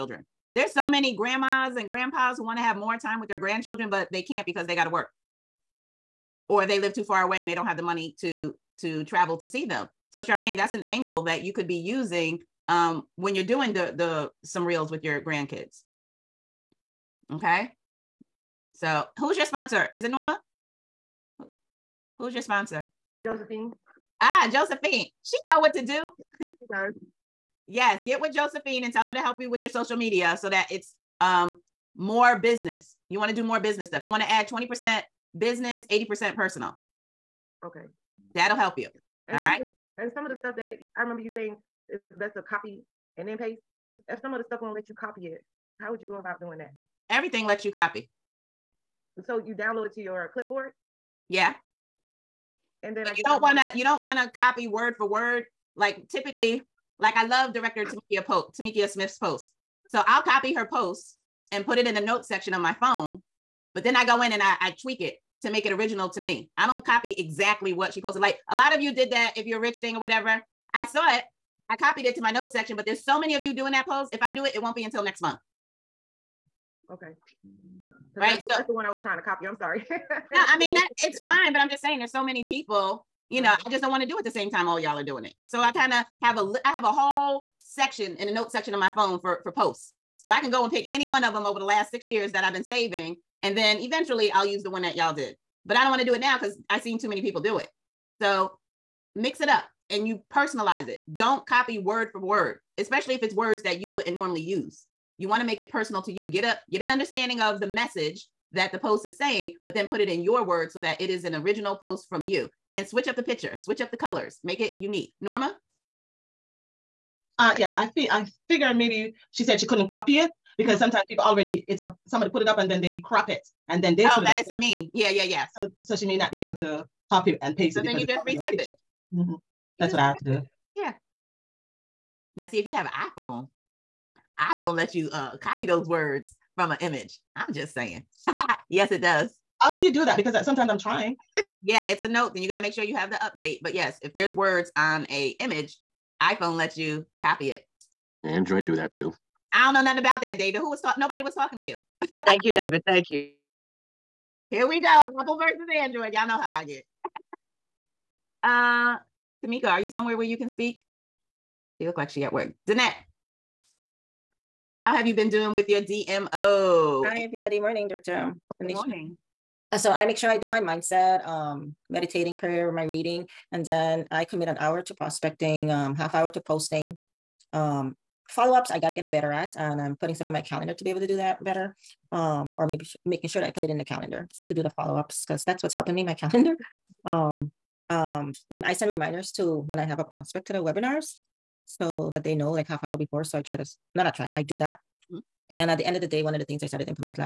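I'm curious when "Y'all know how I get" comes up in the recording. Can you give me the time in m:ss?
2:36.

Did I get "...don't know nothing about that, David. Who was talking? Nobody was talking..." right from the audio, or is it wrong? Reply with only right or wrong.
right.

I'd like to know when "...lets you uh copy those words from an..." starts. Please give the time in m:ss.
2:14.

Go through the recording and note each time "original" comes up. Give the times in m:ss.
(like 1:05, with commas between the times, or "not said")
1:05, 1:51.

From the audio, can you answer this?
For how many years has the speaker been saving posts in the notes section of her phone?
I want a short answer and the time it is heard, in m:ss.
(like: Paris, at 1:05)
6 years, at 1:31.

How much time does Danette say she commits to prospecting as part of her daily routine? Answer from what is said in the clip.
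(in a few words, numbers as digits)
an hour.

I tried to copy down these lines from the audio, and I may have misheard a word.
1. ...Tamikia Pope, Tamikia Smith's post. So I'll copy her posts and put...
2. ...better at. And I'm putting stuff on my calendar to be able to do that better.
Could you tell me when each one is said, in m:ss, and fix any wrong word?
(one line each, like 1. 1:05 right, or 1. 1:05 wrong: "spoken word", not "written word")
1. 0:57 right
2. 2:59 right.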